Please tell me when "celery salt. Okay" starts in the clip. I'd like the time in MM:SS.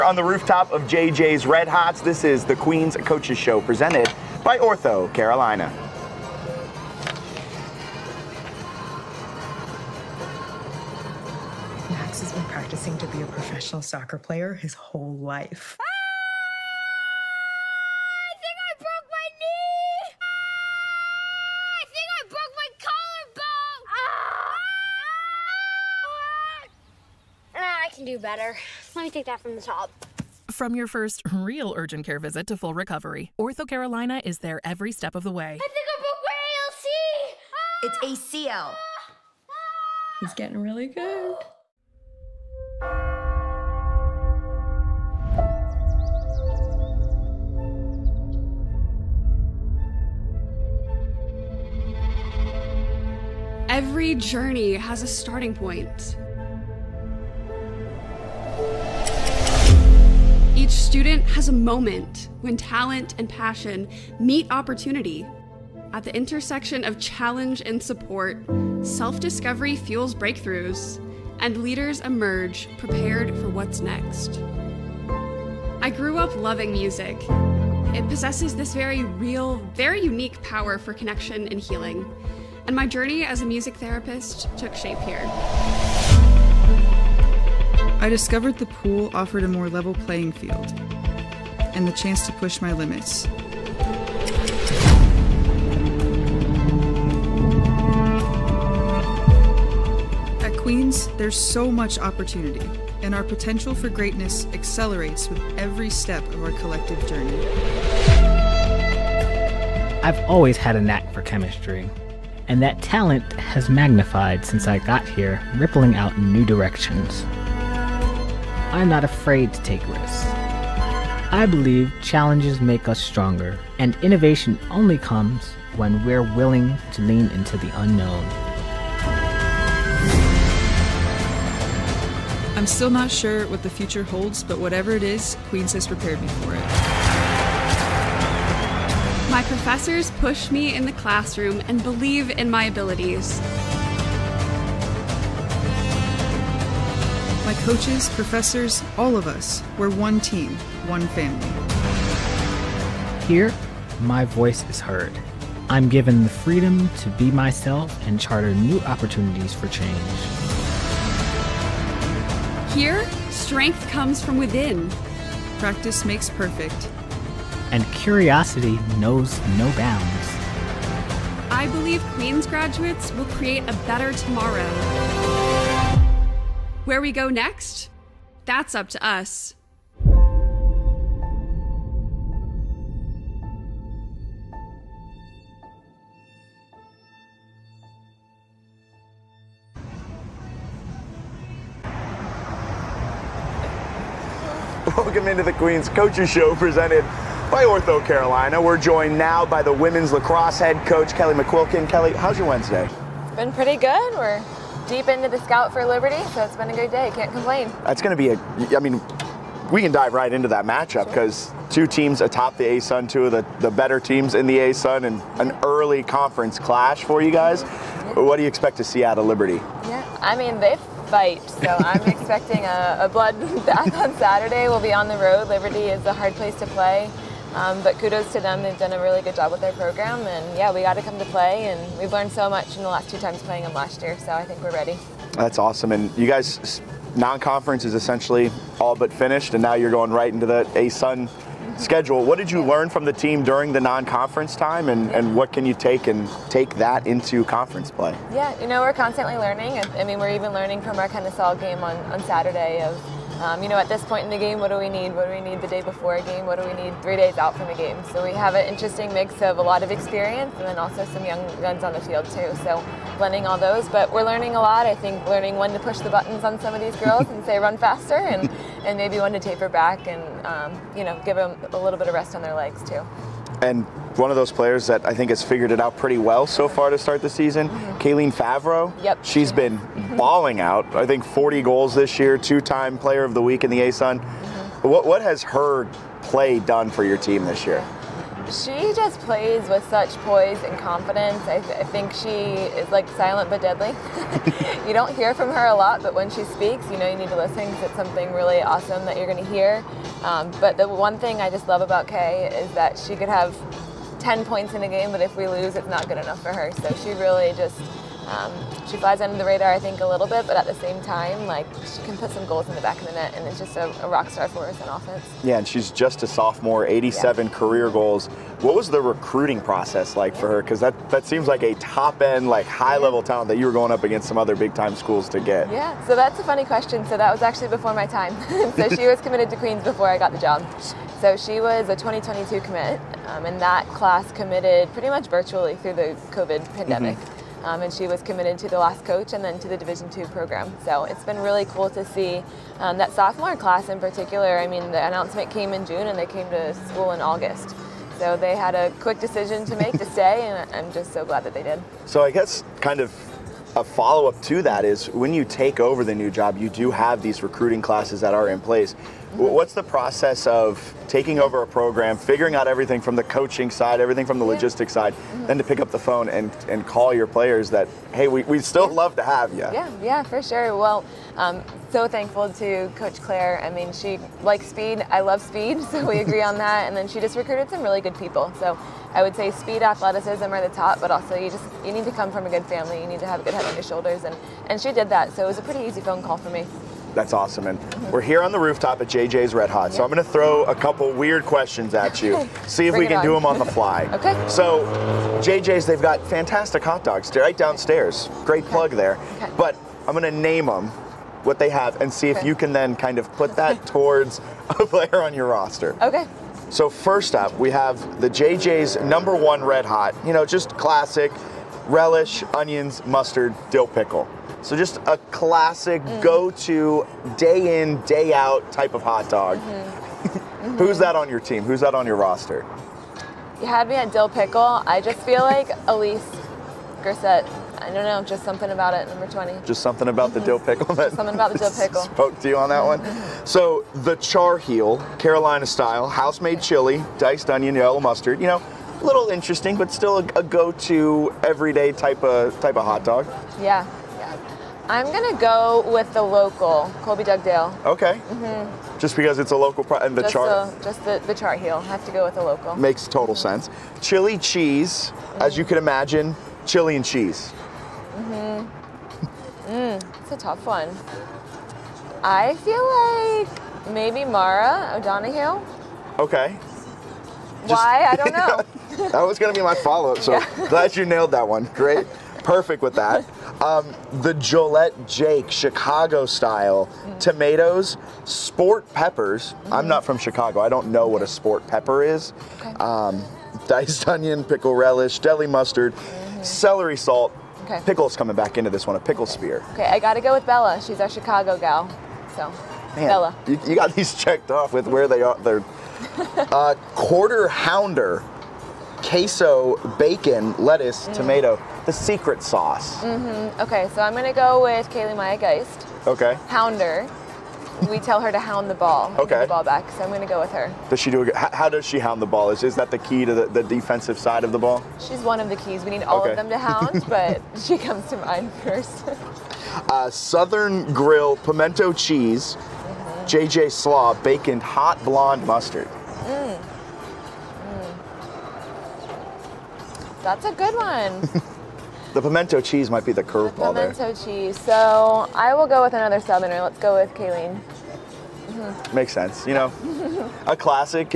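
08:06.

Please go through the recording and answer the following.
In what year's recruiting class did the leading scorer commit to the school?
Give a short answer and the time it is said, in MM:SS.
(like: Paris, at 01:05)
2022, at 05:31.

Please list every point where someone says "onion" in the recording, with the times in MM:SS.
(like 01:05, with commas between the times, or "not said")
06:52, 07:17, 08:04.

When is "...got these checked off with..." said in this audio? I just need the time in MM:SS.
08:13.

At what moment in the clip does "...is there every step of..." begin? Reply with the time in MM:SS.
00:34.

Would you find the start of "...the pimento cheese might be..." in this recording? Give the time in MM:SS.
08:52.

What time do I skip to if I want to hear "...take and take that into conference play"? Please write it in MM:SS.
04:05.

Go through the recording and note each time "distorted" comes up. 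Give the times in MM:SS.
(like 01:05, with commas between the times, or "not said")
not said.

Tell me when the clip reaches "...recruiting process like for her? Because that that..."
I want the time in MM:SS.
05:19.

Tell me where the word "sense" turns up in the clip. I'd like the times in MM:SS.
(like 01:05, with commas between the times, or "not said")
07:33, 08:59.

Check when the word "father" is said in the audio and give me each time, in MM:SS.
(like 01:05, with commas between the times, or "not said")
not said.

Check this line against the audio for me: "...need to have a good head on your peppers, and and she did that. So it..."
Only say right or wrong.
wrong.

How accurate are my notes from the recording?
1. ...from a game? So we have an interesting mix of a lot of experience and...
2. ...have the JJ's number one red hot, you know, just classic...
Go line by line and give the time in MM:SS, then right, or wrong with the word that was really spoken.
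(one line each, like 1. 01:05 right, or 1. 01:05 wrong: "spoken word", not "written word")
1. 04:17 right
2. 06:47 right.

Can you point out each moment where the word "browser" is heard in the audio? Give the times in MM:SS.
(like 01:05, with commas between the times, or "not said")
not said.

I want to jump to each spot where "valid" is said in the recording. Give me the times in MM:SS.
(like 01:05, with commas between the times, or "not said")
not said.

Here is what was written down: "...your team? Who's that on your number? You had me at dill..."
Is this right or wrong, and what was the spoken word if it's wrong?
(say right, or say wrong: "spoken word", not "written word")
wrong: "roster", not "number".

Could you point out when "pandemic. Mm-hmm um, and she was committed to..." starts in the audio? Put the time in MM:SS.
05:36.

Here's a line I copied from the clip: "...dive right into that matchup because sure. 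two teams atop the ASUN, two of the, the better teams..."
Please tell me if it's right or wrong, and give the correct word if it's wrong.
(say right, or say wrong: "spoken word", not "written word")
right.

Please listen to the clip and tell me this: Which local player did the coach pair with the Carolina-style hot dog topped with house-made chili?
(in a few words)
Colby Dugdale.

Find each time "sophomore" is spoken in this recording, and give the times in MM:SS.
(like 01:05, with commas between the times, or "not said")
05:16, 05:43.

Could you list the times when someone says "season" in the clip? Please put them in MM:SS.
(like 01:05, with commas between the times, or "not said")
04:37.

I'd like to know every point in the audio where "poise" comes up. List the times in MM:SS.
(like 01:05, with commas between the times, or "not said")
04:50.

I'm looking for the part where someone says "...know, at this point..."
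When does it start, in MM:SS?
04:13.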